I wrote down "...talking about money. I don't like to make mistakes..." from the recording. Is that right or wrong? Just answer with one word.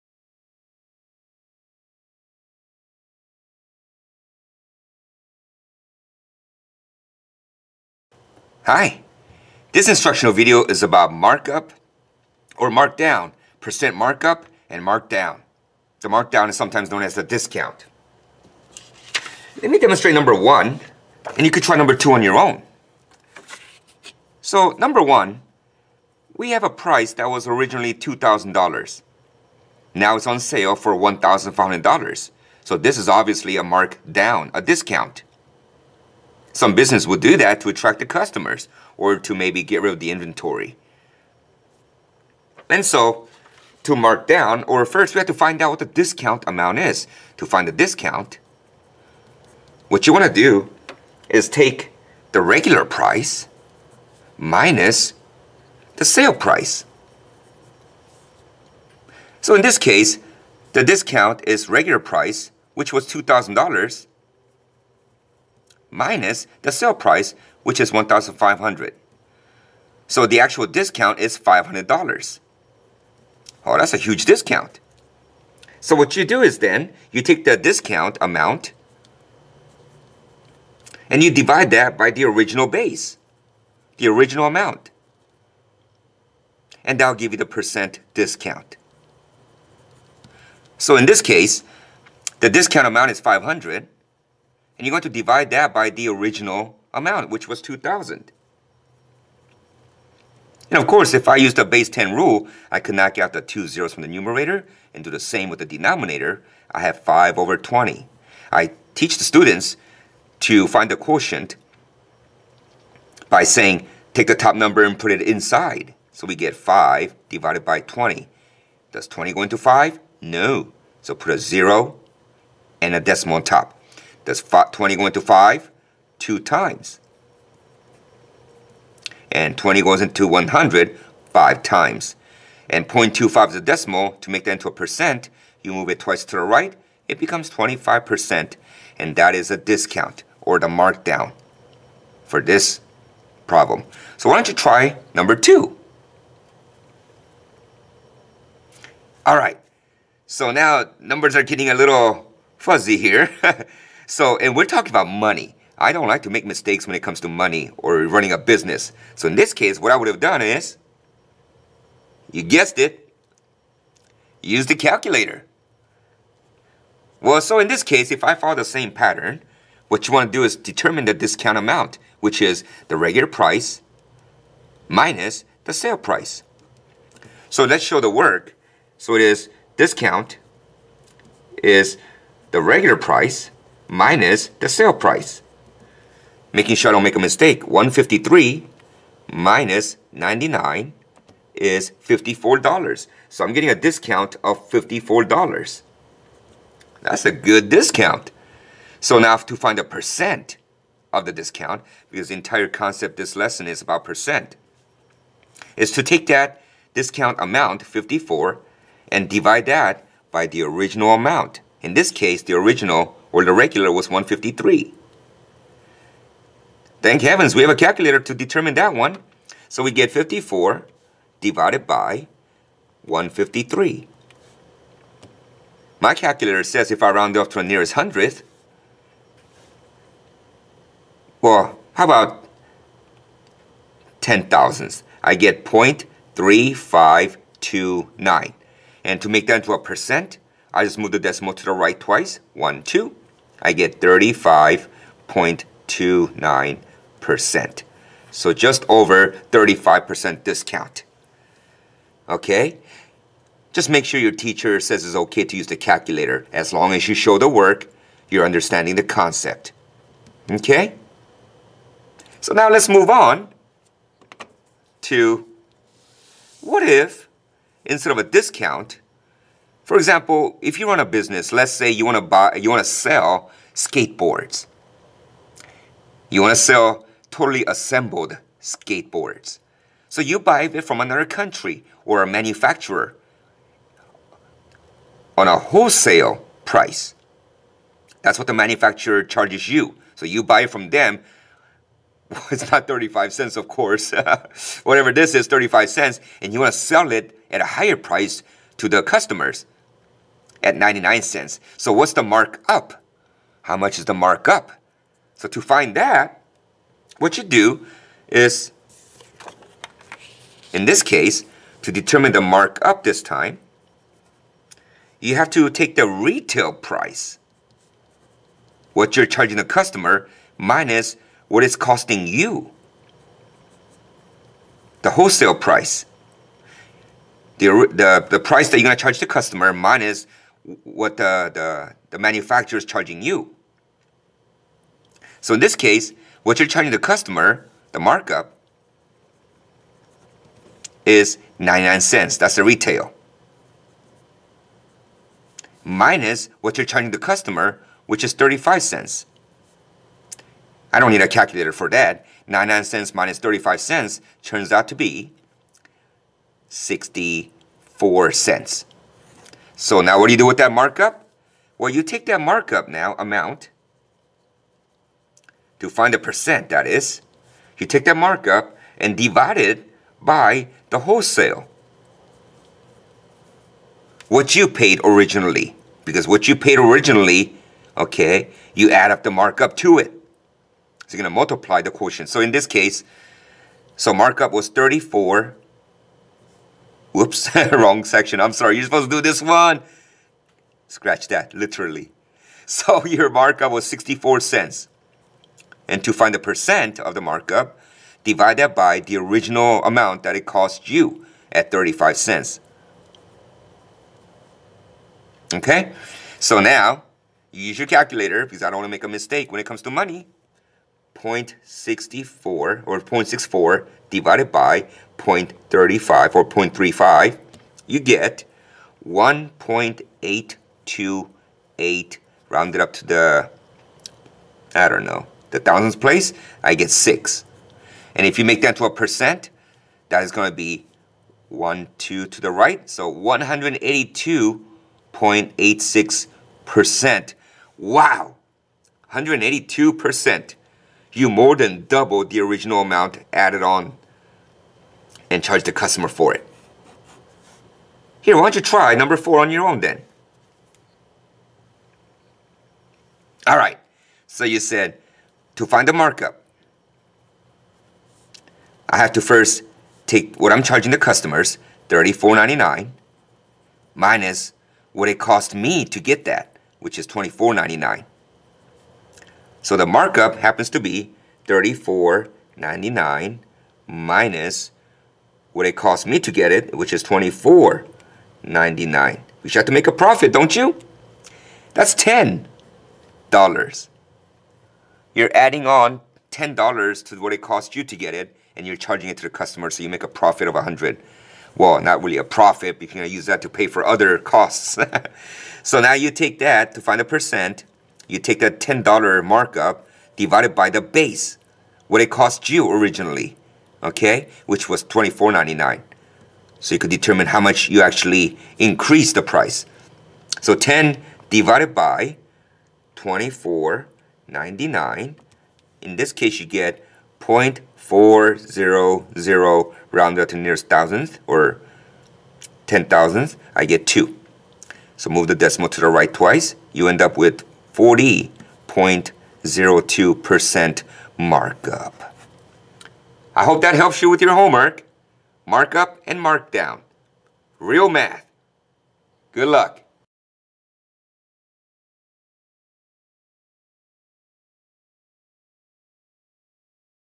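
right.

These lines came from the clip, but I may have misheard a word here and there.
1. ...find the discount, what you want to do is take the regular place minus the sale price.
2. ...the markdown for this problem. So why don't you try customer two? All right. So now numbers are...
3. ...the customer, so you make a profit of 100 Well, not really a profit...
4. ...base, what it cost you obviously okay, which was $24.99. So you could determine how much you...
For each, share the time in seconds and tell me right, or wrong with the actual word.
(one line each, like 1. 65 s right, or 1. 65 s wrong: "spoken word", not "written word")
1. 47 s wrong: "price", not "place"
2. 140 s wrong: "number", not "customer"
3. 489 s right
4. 500 s wrong: "originally", not "obviously".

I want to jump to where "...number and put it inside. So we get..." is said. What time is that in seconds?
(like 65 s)
114 s.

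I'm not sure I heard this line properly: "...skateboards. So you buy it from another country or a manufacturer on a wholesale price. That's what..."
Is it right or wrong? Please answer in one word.
right.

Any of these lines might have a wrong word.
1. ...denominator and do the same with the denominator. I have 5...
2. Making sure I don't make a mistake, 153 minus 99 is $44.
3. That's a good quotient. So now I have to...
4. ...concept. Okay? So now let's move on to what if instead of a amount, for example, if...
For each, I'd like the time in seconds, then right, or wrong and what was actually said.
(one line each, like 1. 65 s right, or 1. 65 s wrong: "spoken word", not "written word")
1. 104 s wrong: "numerator", not "denominator"
2. 186 s wrong: "54", not "44"
3. 197 s wrong: "discount", not "quotient"
4. 259 s wrong: "discount", not "amount".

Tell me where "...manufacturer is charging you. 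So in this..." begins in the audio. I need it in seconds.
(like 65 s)
332 s.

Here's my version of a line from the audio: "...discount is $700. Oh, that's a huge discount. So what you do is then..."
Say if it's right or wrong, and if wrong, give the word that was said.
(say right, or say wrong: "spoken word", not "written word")
wrong: "500", not "700".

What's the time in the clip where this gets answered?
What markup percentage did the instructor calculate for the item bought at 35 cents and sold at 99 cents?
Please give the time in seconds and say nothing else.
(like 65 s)
433 s.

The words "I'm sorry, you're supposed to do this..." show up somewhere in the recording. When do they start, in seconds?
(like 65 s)
388 s.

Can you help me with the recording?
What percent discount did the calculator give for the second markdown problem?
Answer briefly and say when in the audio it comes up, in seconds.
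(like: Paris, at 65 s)
35.29%, at 244 s.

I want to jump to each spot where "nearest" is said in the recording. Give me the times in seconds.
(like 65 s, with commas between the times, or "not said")
227 s, 520 s.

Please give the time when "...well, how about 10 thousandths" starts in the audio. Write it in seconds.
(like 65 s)
231 s.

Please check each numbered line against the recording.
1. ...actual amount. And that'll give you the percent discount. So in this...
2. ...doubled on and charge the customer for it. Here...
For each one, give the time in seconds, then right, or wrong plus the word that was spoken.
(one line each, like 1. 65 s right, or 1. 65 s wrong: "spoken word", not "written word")
1. 84 s wrong: "original", not "actual"
2. 443 s wrong: "added", not "doubled".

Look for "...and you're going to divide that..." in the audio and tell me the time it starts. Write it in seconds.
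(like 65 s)
94 s.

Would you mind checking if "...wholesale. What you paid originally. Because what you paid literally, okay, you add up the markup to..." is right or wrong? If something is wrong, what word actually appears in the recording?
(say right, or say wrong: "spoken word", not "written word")
wrong: "originally", not "literally".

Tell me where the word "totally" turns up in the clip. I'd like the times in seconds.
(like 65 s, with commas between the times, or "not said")
277 s.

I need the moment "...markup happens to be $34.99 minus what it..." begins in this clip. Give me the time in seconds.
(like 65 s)
469 s.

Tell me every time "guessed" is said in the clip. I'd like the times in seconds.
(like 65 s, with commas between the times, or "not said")
162 s.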